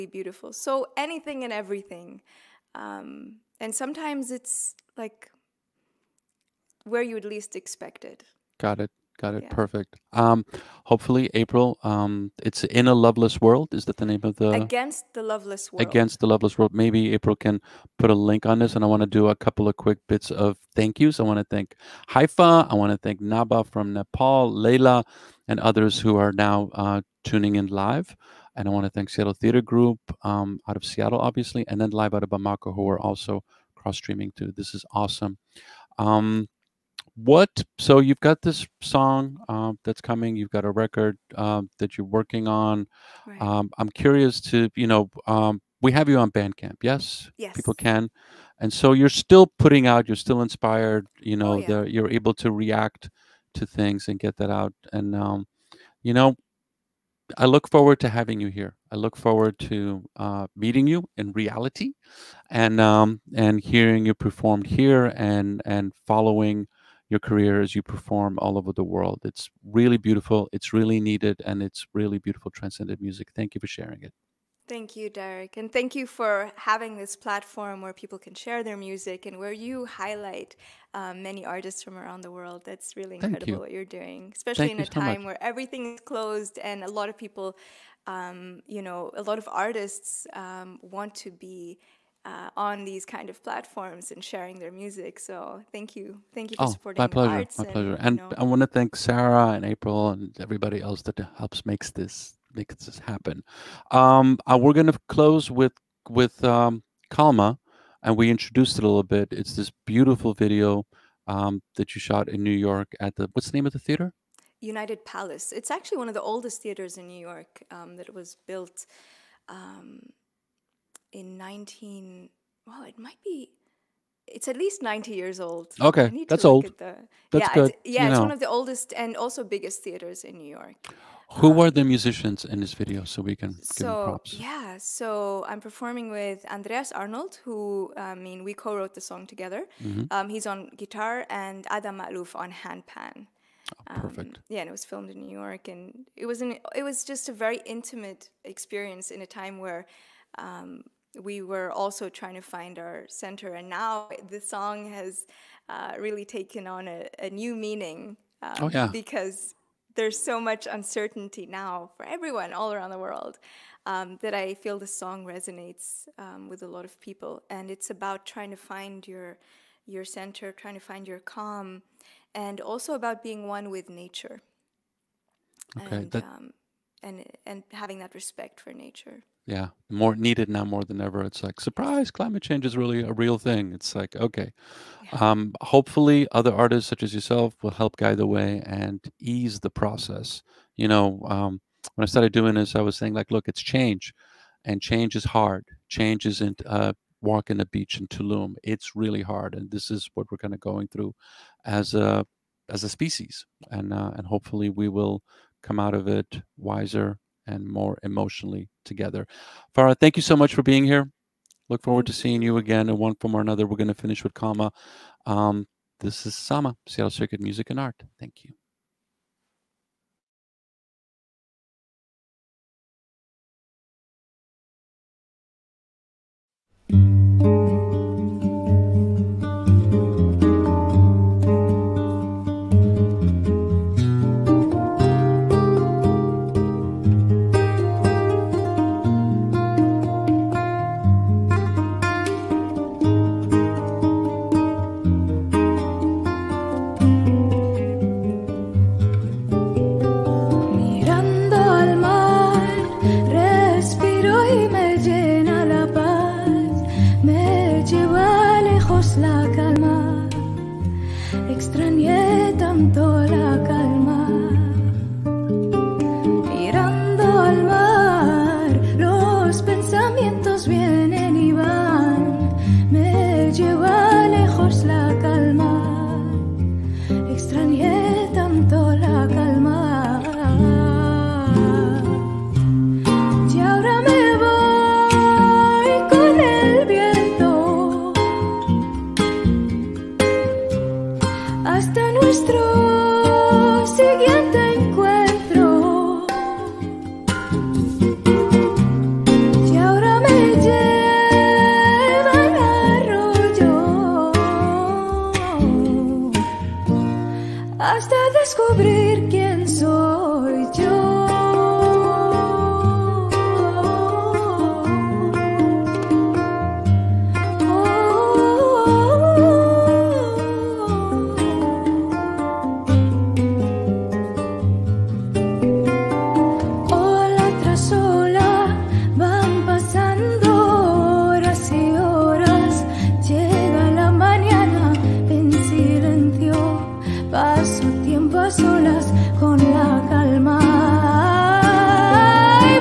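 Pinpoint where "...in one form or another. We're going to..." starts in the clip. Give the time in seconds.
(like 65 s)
212 s.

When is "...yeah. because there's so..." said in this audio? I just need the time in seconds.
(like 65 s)
158 s.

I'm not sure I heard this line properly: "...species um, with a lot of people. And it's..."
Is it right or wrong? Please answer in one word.
wrong.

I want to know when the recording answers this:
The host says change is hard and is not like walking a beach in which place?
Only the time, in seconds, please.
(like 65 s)
198 s.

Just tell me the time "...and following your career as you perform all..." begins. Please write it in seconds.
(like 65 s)
65 s.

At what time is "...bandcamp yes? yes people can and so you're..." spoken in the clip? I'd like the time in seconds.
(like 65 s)
46 s.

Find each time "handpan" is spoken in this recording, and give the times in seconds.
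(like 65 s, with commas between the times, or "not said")
142 s.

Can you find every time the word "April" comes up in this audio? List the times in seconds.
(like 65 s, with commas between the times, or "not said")
11 s, 17 s, 99 s.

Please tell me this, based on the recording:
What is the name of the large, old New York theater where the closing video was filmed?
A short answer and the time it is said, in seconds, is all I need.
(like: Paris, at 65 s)
United Palace, at 114 s.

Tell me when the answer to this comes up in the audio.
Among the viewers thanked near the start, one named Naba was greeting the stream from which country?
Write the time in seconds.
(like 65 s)
23 s.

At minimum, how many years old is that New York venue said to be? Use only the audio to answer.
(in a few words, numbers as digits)
90.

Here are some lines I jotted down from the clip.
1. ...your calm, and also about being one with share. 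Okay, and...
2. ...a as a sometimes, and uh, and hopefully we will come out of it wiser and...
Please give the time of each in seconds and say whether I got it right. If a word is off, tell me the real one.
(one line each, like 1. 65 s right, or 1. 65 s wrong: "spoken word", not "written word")
1. 171 s wrong: "nature", not "share"
2. 201 s wrong: "species", not "sometimes".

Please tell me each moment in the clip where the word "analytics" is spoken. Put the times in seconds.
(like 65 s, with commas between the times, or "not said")
not said.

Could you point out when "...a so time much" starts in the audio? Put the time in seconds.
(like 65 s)
84 s.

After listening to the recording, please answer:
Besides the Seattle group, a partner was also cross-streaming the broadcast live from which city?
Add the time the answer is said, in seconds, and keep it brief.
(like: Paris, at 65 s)
Bamako, at 32 s.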